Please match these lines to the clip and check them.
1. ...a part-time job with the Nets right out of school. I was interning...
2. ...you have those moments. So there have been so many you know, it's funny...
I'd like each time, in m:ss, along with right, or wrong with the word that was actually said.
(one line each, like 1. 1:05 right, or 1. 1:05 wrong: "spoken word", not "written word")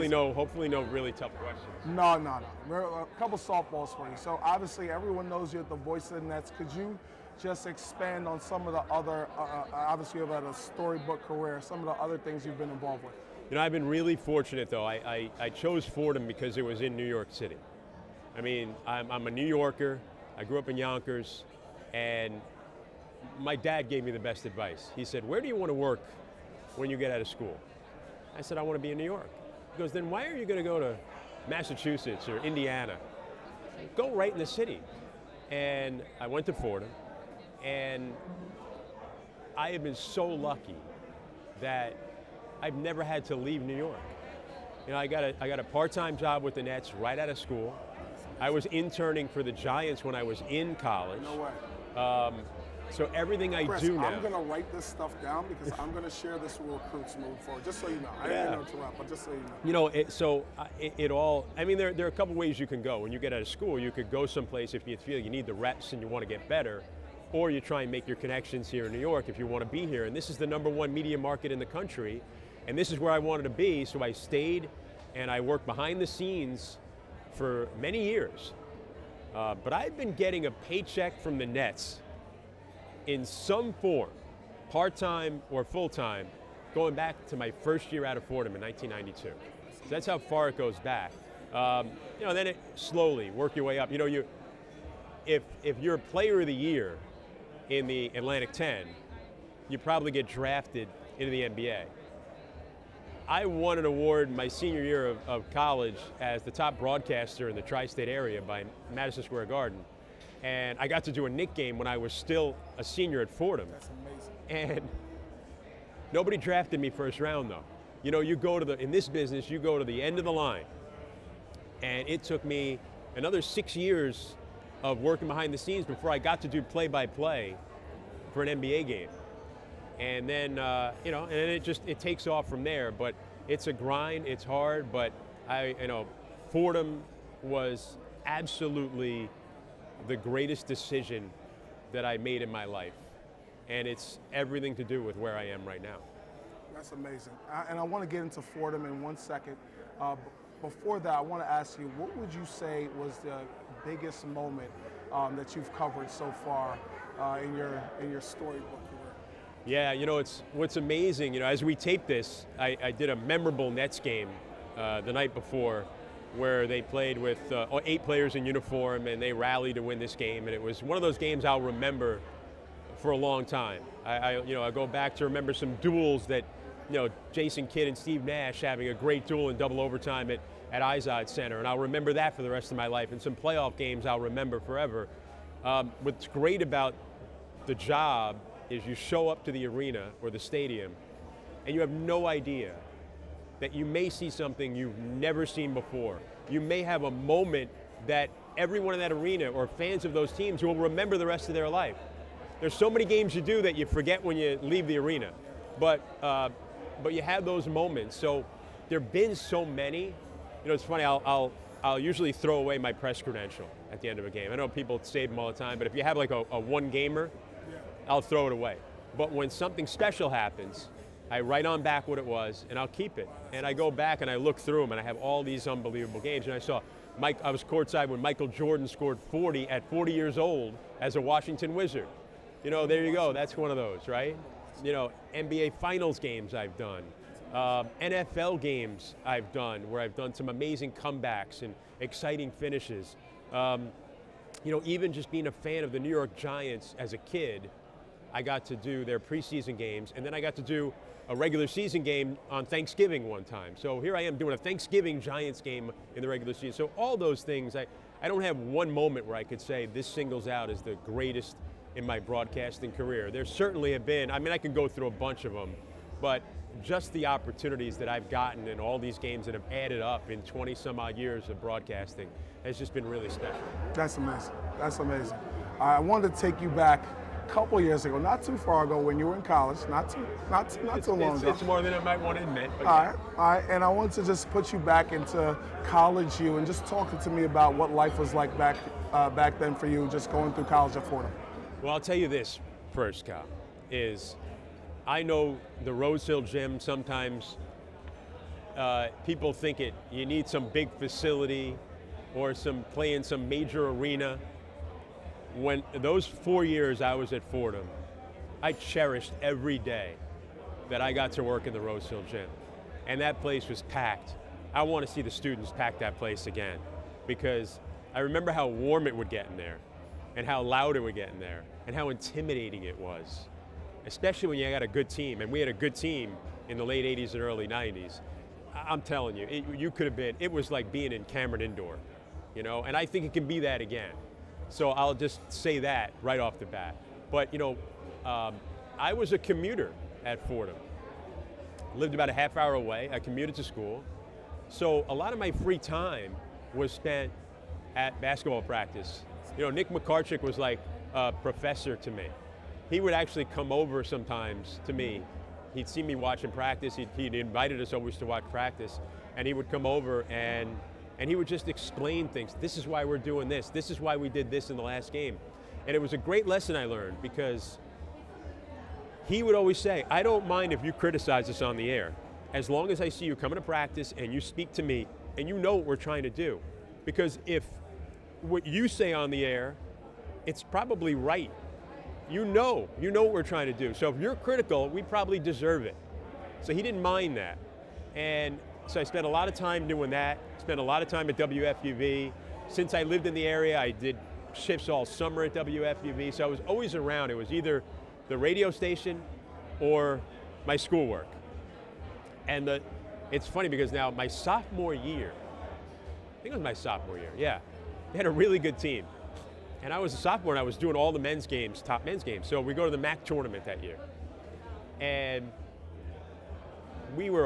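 1. 0:45 right
2. 3:27 right.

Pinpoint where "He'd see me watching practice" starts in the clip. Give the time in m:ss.
5:55.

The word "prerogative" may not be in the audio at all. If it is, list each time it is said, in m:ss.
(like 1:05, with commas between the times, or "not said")
not said.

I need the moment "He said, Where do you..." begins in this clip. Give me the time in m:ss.
0:24.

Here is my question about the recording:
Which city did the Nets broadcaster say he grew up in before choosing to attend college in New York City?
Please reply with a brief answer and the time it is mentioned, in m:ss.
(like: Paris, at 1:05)
Yonkers, at 0:20.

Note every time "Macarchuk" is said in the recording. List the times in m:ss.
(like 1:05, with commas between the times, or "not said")
5:49.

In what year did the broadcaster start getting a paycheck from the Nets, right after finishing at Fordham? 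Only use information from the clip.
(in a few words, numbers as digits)
1992.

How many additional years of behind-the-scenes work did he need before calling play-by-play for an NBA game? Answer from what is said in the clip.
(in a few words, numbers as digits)
6.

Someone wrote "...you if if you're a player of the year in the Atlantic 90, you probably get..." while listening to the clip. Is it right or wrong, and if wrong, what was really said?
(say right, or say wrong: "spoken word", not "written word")
wrong: "10", not "90".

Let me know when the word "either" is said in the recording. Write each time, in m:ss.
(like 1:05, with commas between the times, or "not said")
6:37.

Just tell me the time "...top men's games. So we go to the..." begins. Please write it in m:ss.
6:51.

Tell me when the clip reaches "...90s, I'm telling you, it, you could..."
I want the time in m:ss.
5:27.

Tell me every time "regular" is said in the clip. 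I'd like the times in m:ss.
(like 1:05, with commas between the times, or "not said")
4:11, 4:16.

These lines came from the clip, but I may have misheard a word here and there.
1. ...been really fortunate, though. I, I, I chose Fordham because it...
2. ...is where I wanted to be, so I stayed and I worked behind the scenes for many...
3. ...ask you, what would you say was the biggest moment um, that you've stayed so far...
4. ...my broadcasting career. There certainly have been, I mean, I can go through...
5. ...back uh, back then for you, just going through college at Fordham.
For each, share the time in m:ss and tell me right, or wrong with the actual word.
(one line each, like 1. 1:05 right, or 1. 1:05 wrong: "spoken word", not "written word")
1. 0:13 right
2. 1:12 right
3. 2:31 wrong: "covered", not "stayed"
4. 4:22 right
5. 4:48 right.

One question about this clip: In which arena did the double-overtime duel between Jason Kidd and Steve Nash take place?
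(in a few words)
Izod Center.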